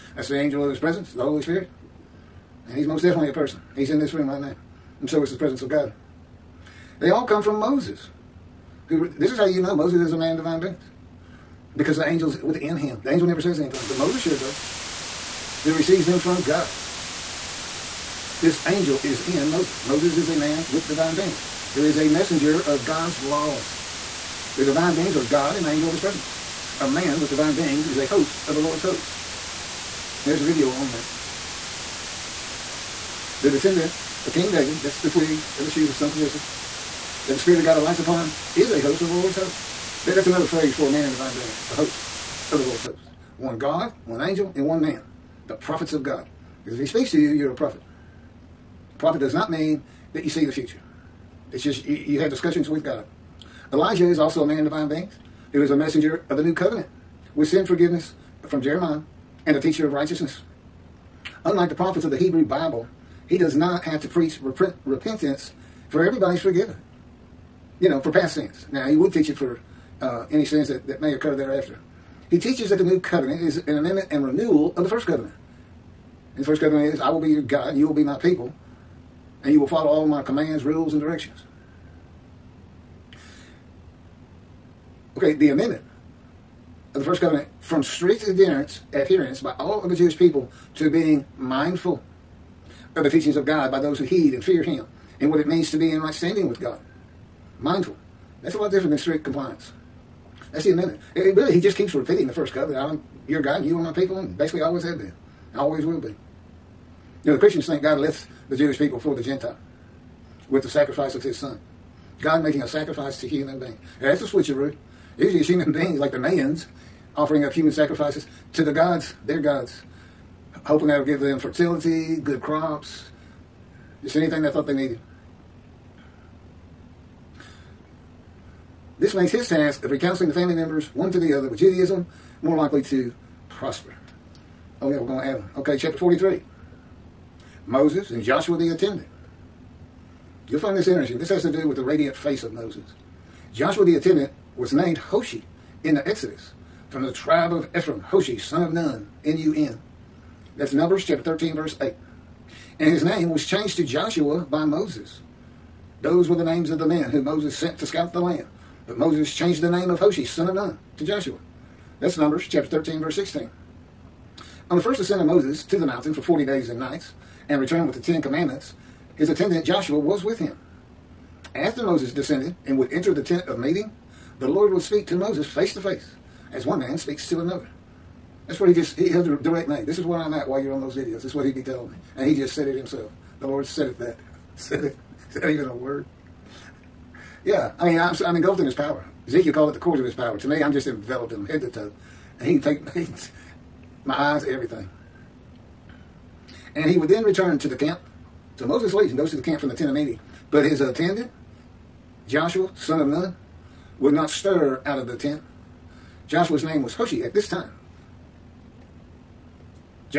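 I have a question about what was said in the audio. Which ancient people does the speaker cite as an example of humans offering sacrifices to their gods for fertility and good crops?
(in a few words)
Mayans.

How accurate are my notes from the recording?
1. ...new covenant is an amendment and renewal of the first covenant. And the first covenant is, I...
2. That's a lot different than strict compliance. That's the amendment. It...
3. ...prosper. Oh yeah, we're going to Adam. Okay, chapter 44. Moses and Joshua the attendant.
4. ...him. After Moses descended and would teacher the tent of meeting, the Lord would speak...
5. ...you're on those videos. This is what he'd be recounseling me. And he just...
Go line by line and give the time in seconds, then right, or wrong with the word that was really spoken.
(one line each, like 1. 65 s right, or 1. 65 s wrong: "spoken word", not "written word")
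1. 72 s right
2. 98 s right
3. 133 s wrong: "43", not "44"
4. 170 s wrong: "enter", not "teacher"
5. 180 s wrong: "telling", not "recounseling".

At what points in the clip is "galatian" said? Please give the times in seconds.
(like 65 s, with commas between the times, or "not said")
not said.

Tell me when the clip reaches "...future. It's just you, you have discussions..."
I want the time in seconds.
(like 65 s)
50 s.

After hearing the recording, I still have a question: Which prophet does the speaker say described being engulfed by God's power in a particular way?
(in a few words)
Ezekiel.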